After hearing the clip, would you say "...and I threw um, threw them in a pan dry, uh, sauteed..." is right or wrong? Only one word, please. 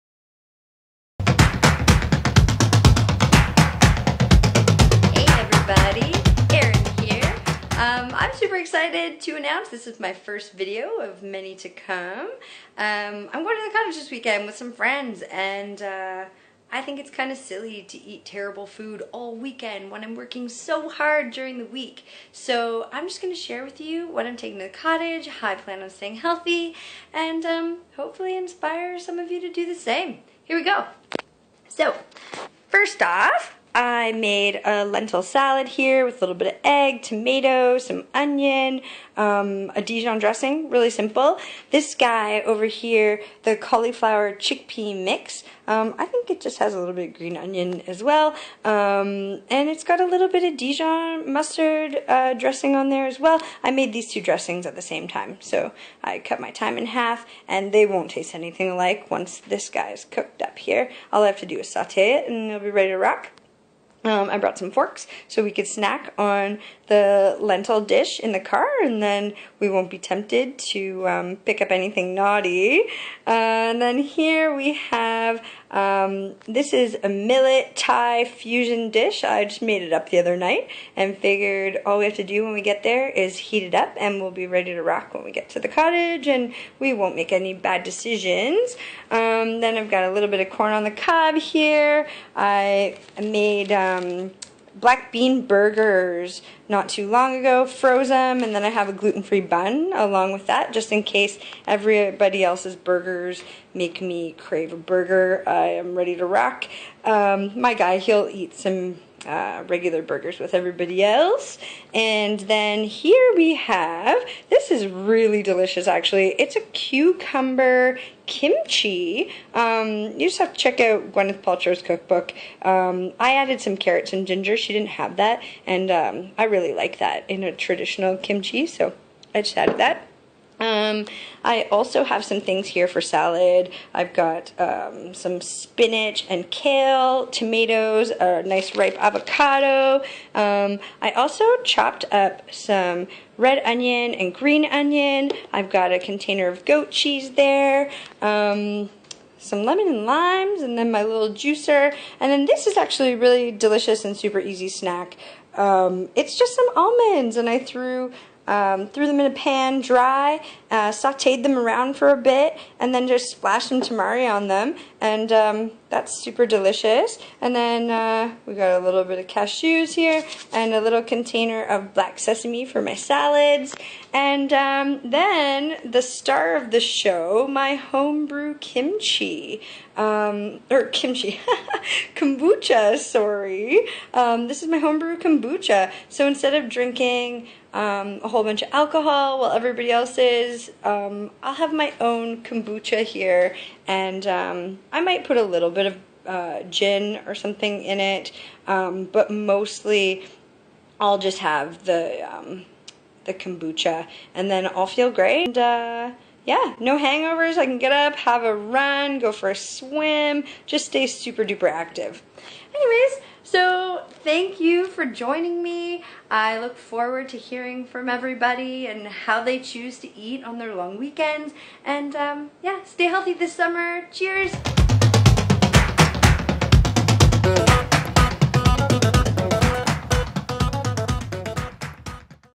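right.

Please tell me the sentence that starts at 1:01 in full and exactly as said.
All I have to do is saute it, and it'll be ready to rock.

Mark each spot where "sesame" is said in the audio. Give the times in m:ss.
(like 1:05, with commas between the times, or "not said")
2:52.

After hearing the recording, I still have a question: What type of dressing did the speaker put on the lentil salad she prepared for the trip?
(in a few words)
Dijon dressing.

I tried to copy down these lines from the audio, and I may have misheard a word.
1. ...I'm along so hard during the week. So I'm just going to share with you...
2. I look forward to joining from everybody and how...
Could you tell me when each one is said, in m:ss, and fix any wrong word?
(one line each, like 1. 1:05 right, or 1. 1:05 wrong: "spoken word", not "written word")
1. 0:20 wrong: "working", not "along"
2. 3:36 wrong: "hearing", not "joining".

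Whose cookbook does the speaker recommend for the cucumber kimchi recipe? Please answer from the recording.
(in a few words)
Gwyneth Paltrow.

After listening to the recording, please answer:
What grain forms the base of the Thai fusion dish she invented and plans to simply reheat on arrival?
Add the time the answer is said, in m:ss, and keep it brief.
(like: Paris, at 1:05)
Millet, at 1:17.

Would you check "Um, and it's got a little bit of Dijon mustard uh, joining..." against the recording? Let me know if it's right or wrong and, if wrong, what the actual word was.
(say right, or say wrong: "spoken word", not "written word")
wrong: "dressing", not "joining".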